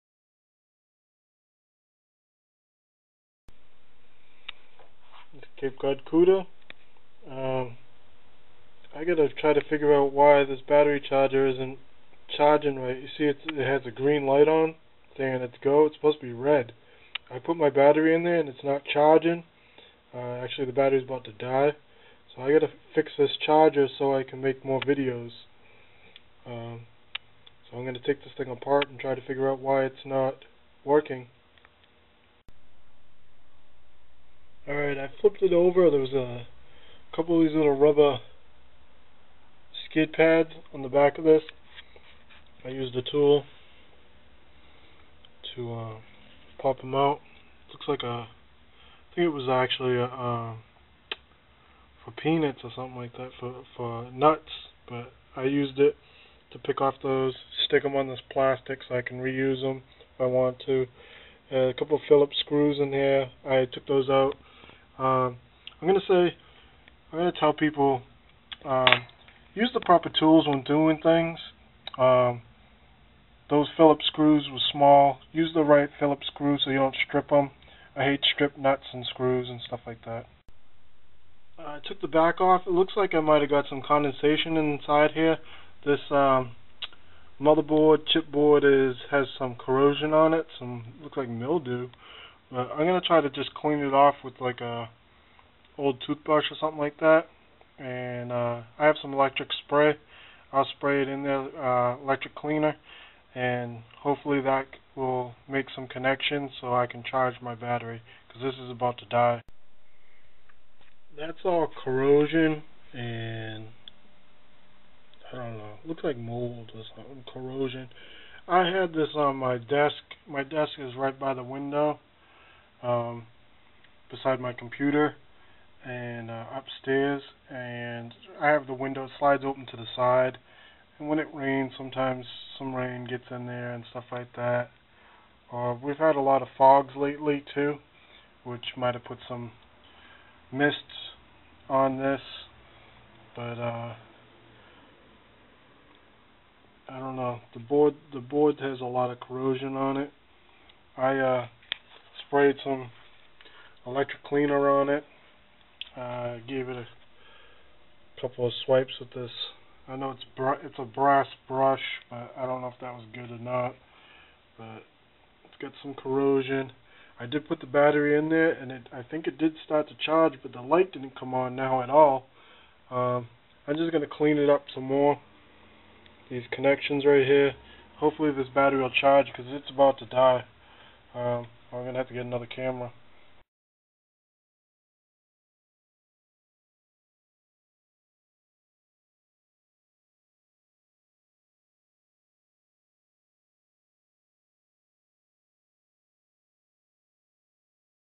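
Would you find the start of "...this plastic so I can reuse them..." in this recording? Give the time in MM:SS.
00:58.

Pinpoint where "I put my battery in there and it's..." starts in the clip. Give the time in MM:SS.
00:17.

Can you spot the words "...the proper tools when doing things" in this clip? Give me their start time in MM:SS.
01:09.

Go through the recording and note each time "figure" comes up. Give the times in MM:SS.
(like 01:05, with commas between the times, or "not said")
00:09, 00:29.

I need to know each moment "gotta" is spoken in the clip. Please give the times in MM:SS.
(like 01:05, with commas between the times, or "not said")
00:09, 00:22.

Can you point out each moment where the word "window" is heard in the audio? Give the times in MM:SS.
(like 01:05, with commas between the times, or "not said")
02:01, 02:08.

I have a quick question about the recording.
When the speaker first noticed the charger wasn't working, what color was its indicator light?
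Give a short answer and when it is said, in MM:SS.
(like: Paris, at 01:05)
green, at 00:13.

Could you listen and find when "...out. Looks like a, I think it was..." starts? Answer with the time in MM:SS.
00:46.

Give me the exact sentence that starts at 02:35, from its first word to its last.
Uh, gave it a couple of swipes with this.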